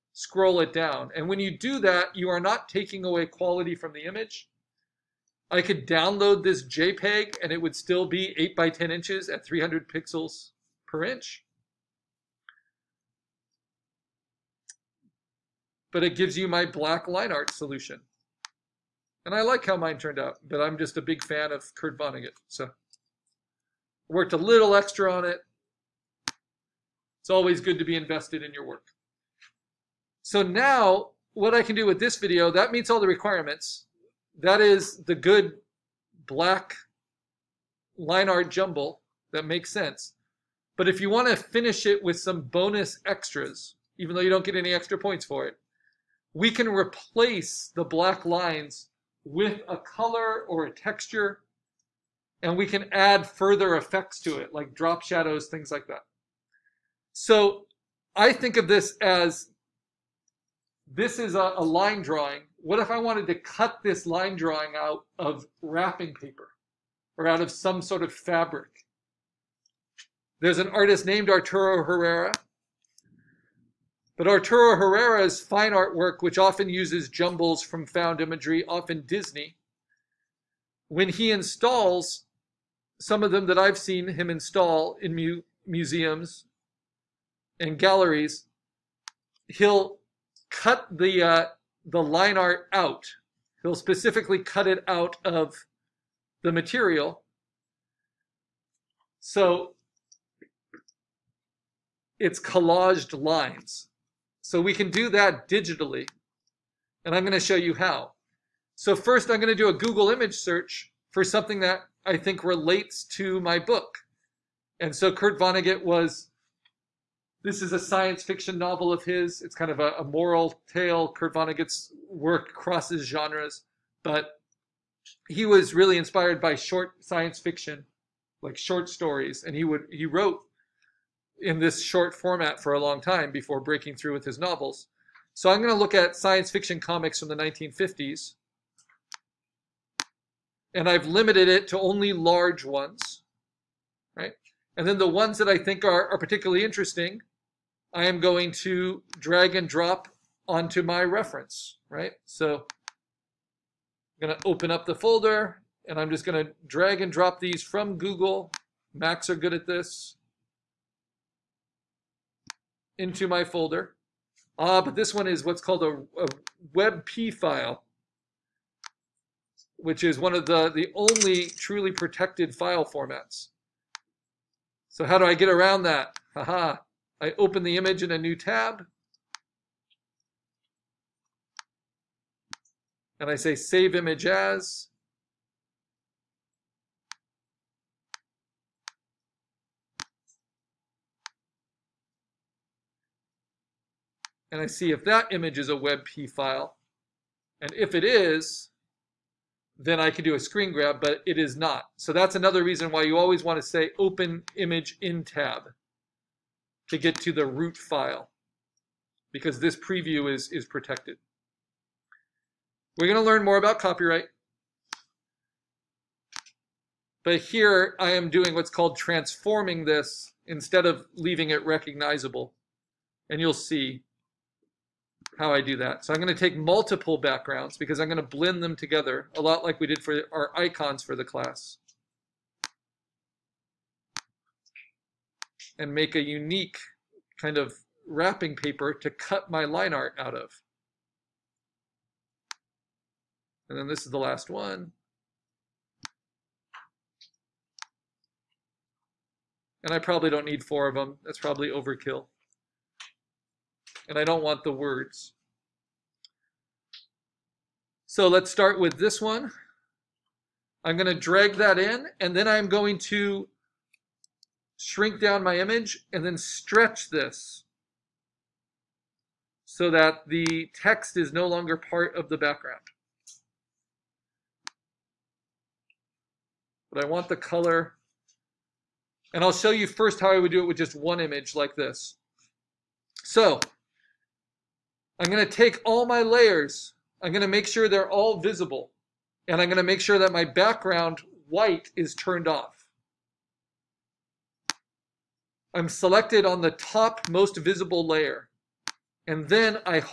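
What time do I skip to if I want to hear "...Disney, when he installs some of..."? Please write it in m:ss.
1:19.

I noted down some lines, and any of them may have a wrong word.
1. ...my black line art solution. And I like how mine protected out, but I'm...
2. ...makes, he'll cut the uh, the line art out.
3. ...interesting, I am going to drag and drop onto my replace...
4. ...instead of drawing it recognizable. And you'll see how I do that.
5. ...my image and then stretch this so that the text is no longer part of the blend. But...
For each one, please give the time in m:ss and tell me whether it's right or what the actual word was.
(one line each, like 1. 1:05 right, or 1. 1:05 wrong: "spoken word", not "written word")
1. 0:16 wrong: "turned", not "protected"
2. 1:27 wrong: "galleries", not "makes"
3. 2:26 wrong: "reference", not "replace"
4. 3:40 wrong: "leaving", not "drawing"
5. 4:25 wrong: "background", not "blend".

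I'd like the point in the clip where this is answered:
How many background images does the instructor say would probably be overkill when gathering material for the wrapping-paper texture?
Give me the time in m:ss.
4:10.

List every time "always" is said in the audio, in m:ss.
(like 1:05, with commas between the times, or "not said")
0:27, 3:23.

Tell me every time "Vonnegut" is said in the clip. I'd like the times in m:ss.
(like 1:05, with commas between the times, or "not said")
0:21, 1:55, 2:01.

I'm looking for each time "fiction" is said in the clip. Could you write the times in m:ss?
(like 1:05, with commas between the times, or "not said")
1:58, 2:07, 2:16.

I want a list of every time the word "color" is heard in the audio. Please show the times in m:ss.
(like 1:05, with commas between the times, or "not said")
0:49, 4:37.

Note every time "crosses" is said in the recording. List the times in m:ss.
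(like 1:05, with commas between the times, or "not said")
2:02.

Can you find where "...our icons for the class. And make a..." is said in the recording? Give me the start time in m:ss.
3:50.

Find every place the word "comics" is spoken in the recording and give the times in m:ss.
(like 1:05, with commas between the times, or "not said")
2:16.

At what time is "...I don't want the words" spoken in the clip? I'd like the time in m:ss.
4:14.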